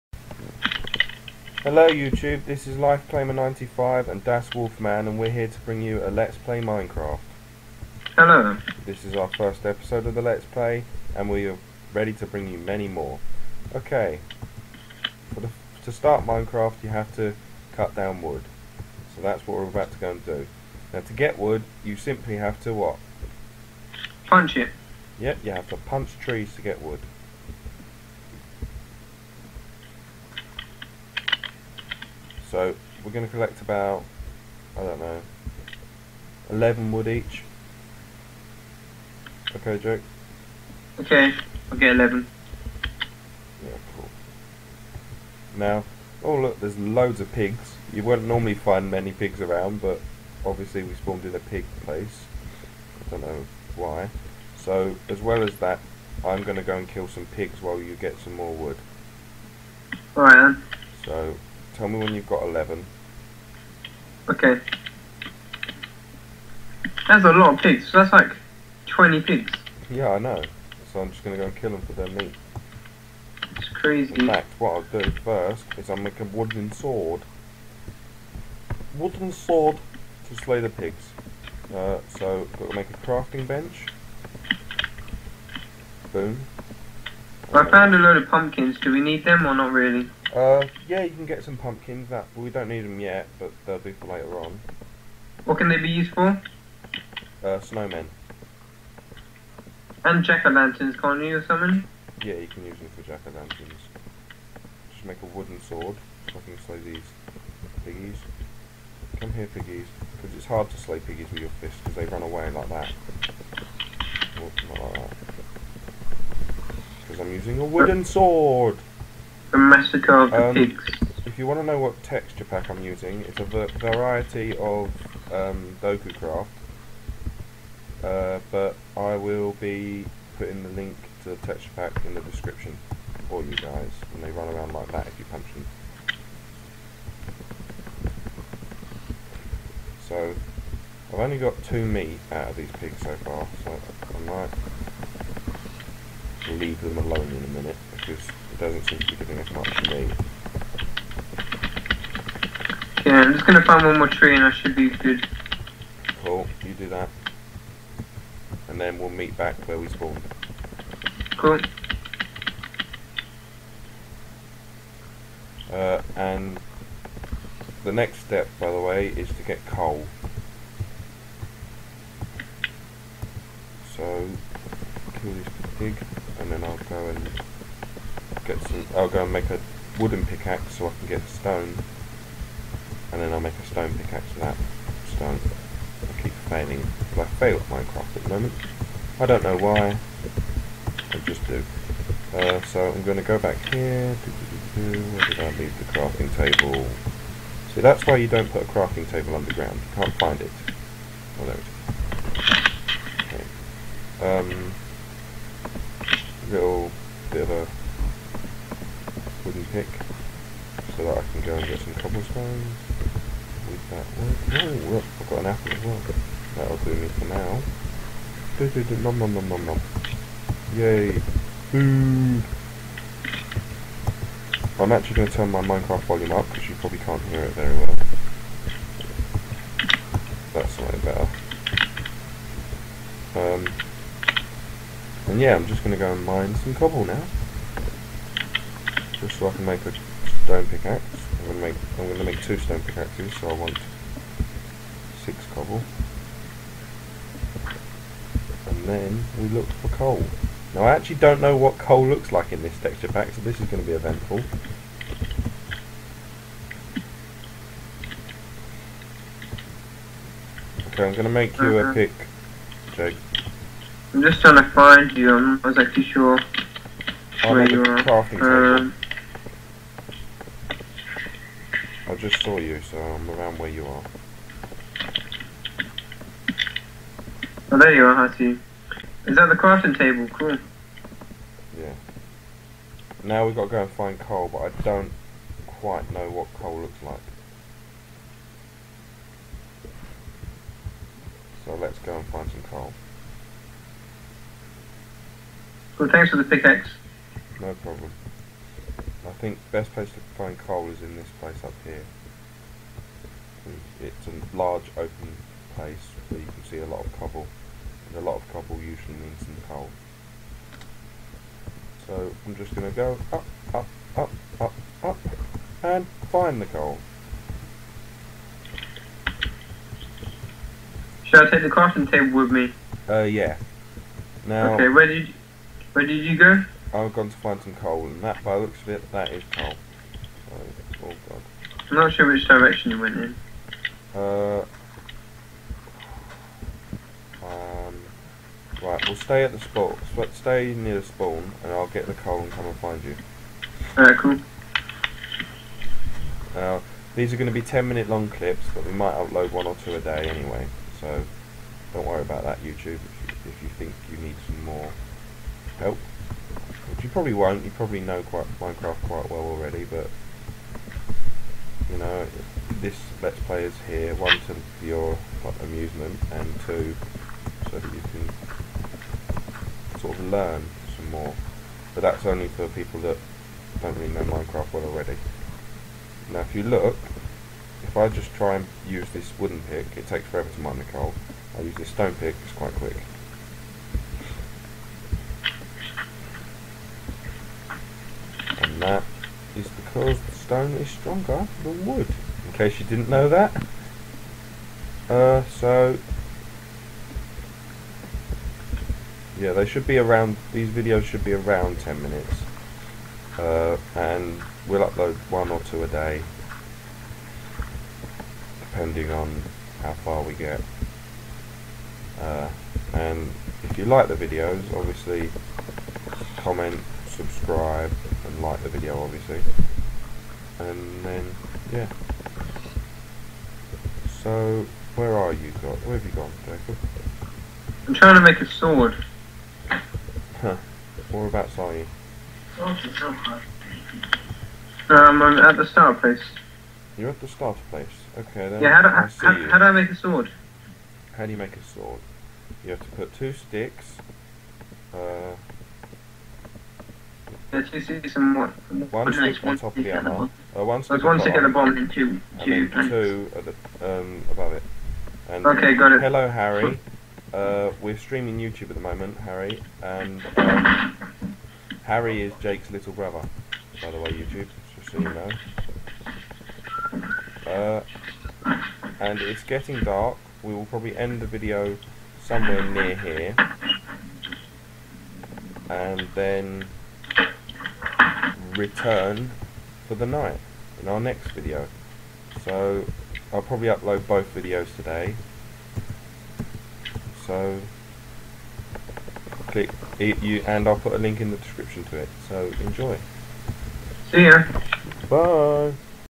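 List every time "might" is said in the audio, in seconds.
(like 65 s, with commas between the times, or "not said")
146 s, 348 s.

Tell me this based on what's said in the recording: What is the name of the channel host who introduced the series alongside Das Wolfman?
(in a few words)
LifeClaimer95.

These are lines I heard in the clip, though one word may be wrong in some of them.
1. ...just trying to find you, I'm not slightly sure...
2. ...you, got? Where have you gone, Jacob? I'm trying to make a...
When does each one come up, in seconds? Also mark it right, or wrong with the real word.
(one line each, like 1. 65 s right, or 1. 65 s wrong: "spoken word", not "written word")
1. 264 s wrong: "exactly", not "slightly"
2. 425 s right.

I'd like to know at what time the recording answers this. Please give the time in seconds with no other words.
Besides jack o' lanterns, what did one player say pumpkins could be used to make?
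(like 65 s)
97 s.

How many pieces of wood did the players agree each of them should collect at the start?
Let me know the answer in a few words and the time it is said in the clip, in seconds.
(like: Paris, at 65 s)
11, at 36 s.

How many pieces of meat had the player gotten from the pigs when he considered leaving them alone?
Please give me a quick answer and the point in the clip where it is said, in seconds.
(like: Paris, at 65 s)
2, at 141 s.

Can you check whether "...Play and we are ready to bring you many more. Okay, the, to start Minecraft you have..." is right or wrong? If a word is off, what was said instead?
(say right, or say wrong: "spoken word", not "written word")
right.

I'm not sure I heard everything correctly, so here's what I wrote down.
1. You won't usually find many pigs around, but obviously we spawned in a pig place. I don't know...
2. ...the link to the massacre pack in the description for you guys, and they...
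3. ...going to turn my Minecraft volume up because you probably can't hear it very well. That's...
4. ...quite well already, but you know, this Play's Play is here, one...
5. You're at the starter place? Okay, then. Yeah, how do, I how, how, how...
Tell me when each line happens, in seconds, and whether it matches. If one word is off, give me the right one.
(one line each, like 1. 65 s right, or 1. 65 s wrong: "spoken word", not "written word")
1. 47 s wrong: "normally", not "usually"
2. 130 s wrong: "texture", not "massacre"
3. 225 s right
4. 359 s wrong: "Let", not "Play"
5. 436 s right.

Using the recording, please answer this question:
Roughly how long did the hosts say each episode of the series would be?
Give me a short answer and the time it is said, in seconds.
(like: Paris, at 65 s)
10 minutes, at 347 s.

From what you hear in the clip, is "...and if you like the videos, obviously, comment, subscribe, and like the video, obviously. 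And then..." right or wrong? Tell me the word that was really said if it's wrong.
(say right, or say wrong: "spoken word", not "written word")
right.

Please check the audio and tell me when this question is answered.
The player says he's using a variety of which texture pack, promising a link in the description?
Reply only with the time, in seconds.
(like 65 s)
125 s.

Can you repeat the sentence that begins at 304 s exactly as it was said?
It's a large open place where you can see a lot of cobble because a lot of cobble usually means some coal.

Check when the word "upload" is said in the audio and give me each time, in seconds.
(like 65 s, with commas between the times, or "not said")
349 s, 404 s, 483 s.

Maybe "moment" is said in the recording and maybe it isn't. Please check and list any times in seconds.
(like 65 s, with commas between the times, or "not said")
188 s, 458 s.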